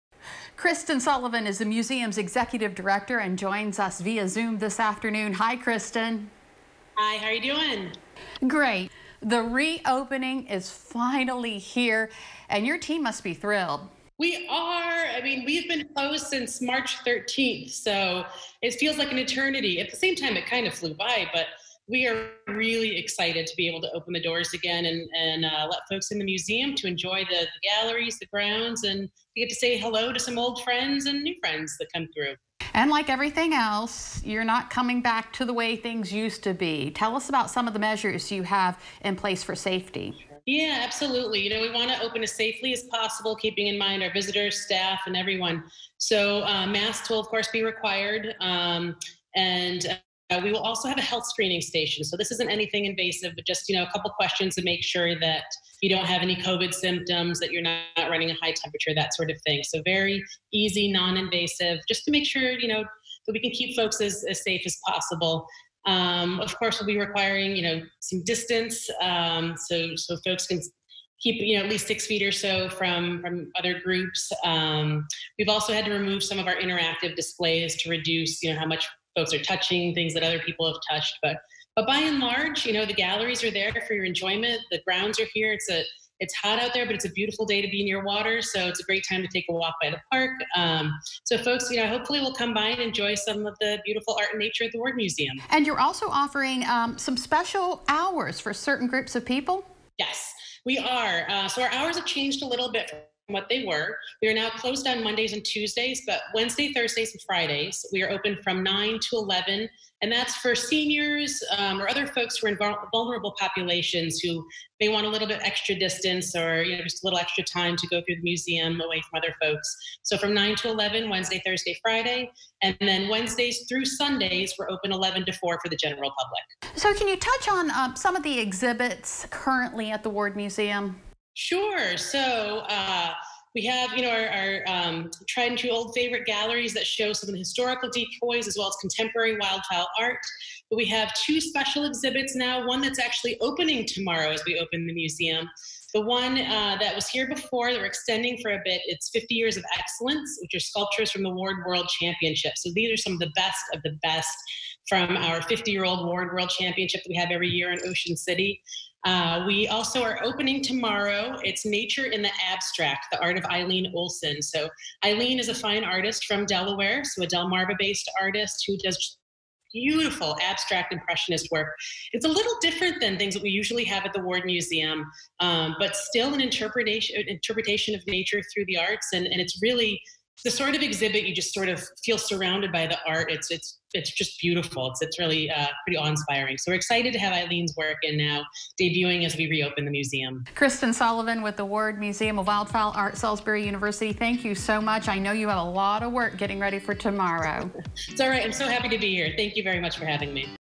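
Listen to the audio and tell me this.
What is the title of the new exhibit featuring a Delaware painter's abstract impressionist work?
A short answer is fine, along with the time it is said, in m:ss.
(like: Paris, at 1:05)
Nature in the Abstract, at 2:41.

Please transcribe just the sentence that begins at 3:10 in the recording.
Kristen Sullivan with the Ward Museum of Wildfowl Art, Salisbury University.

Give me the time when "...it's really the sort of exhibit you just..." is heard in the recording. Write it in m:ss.
2:59.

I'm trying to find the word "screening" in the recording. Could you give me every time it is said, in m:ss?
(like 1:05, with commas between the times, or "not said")
0:51.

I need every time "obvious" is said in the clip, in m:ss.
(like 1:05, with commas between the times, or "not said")
not said.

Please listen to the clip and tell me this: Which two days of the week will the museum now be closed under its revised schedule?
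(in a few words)
Mondays and Tuesdays.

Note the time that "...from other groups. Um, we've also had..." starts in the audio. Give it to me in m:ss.
1:13.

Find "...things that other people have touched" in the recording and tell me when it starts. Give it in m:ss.
1:19.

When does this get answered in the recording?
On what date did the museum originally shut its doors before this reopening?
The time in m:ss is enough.
0:16.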